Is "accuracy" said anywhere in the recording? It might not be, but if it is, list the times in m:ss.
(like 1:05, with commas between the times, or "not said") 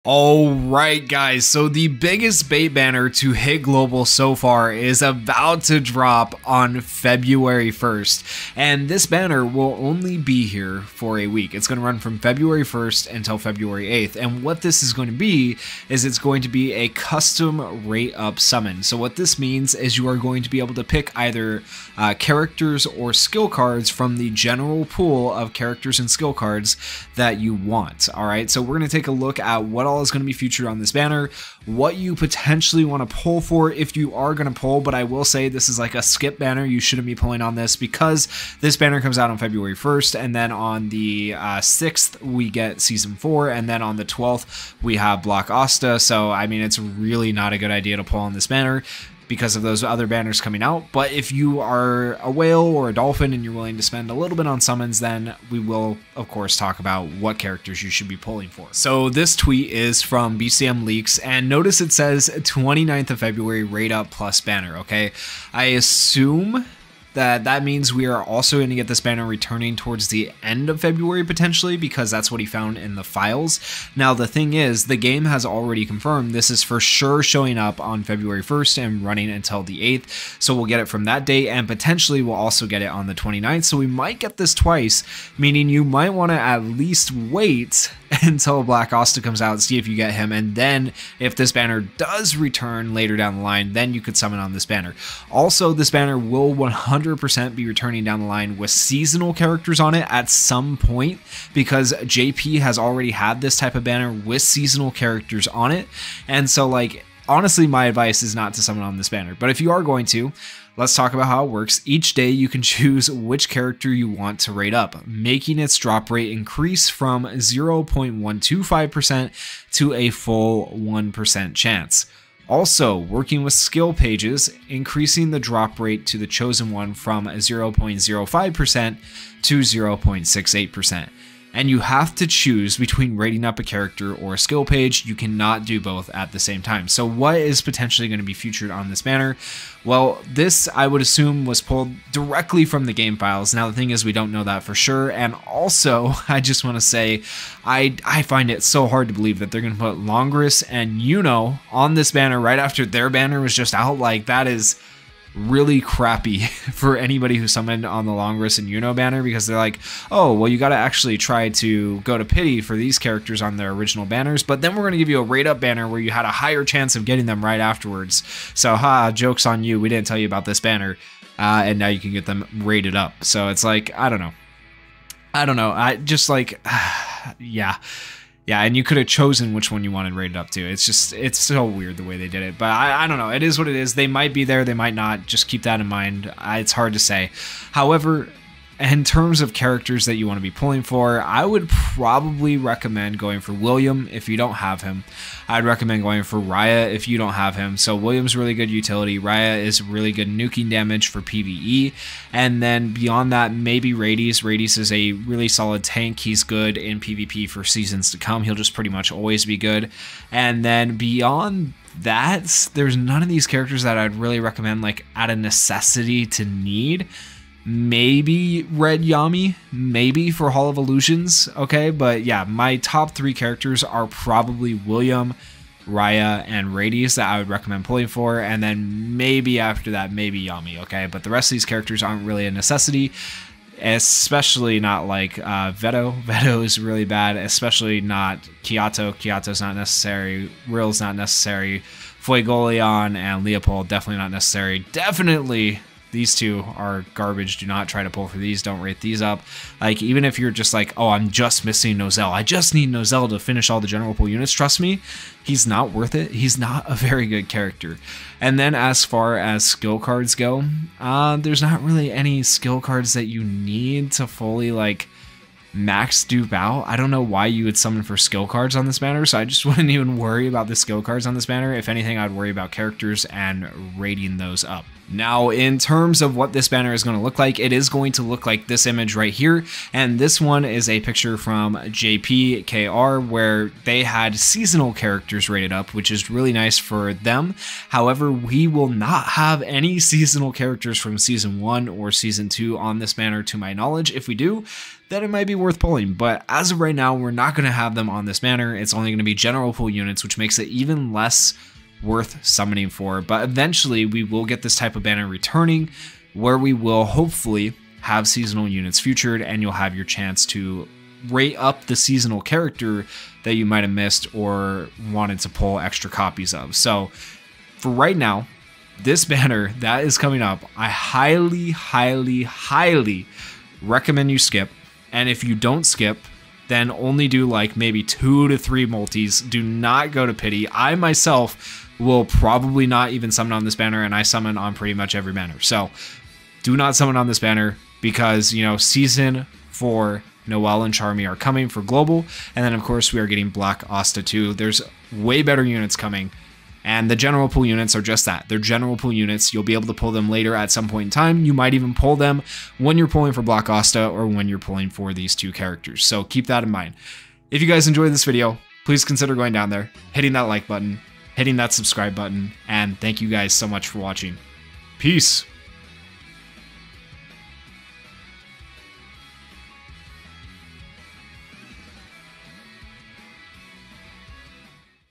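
not said.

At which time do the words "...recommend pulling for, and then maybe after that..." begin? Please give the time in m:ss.
3:47.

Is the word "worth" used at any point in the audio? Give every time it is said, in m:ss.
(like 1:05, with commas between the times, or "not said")
4:15, 4:55, 5:02.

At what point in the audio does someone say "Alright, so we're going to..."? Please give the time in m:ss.
0:28.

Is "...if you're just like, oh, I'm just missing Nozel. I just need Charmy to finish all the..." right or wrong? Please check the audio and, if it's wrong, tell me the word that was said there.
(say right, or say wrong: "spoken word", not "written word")
wrong: "Nozel", not "Charmy".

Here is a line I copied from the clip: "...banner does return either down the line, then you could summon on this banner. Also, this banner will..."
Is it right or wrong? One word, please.
wrong.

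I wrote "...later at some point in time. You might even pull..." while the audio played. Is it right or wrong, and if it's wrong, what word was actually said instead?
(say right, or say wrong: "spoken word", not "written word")
right.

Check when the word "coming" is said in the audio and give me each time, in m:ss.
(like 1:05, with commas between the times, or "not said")
0:50, 5:20, 5:41, 5:45.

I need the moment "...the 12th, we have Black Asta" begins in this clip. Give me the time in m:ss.
0:43.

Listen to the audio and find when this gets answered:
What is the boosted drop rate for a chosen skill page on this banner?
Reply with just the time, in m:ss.
2:09.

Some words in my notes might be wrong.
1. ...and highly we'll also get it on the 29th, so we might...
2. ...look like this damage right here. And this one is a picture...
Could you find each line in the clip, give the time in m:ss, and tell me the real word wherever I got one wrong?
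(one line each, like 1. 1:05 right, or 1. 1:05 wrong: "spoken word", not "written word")
1. 1:21 wrong: "potentially", not "highly"
2. 4:38 wrong: "image", not "damage".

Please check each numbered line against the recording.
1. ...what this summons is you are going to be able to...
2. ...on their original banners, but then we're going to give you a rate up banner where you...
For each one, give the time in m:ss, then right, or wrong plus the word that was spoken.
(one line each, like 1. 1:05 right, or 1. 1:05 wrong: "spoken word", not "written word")
1. 0:18 wrong: "means", not "summons"
2. 2:43 right.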